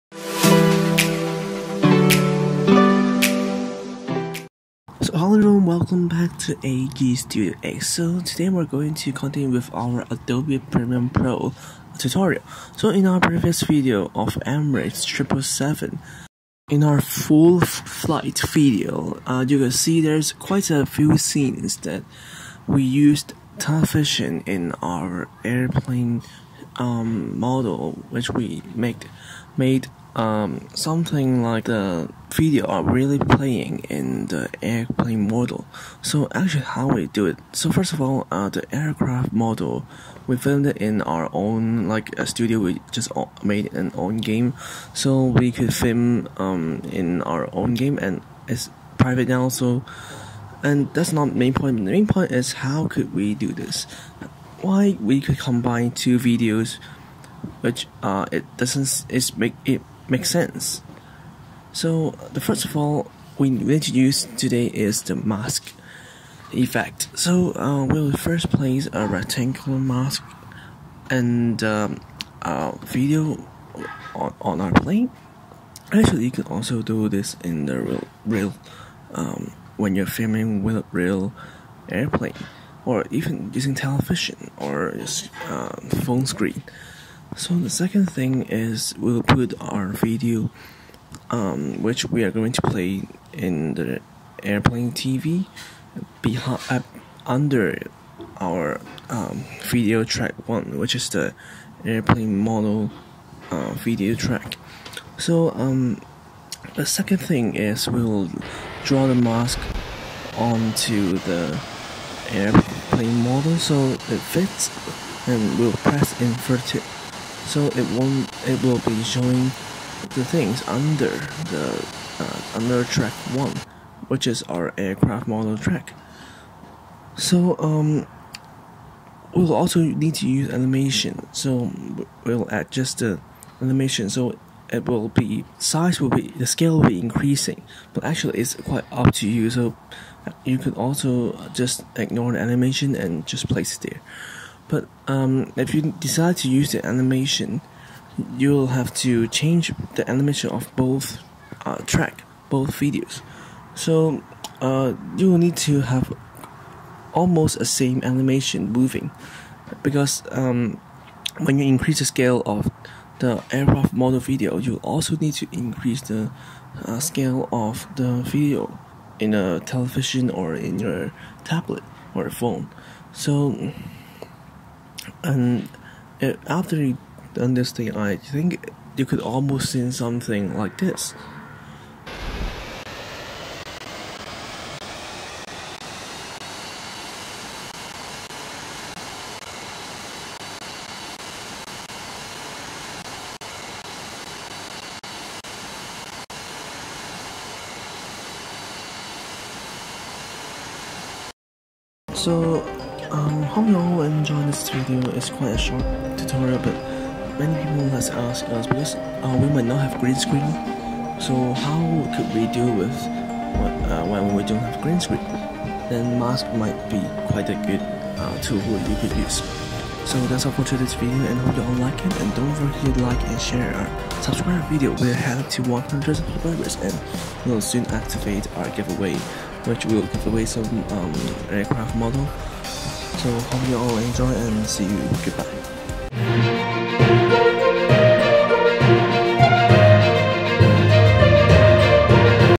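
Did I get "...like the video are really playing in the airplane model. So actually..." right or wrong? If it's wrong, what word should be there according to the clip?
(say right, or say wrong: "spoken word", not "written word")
right.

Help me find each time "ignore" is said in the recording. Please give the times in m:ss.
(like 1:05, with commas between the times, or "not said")
2:21.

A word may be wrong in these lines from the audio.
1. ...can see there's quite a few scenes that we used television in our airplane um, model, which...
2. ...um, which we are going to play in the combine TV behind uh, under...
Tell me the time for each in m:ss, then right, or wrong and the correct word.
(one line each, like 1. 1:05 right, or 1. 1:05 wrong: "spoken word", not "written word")
1. 0:19 right
2. 1:31 wrong: "airplane", not "combine".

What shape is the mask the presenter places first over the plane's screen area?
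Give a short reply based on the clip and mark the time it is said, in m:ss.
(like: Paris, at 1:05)
Rectangular, at 1:09.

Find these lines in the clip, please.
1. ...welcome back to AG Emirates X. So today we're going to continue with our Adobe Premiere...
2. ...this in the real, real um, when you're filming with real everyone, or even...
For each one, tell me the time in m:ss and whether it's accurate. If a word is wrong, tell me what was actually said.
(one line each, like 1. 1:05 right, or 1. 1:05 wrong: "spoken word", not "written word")
1. 0:05 wrong: "Studio", not "Emirates"
2. 1:17 wrong: "airplane", not "everyone".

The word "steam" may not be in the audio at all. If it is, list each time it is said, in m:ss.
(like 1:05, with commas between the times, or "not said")
not said.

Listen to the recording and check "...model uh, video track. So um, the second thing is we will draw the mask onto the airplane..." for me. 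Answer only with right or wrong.
right.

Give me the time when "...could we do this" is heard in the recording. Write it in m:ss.
0:52.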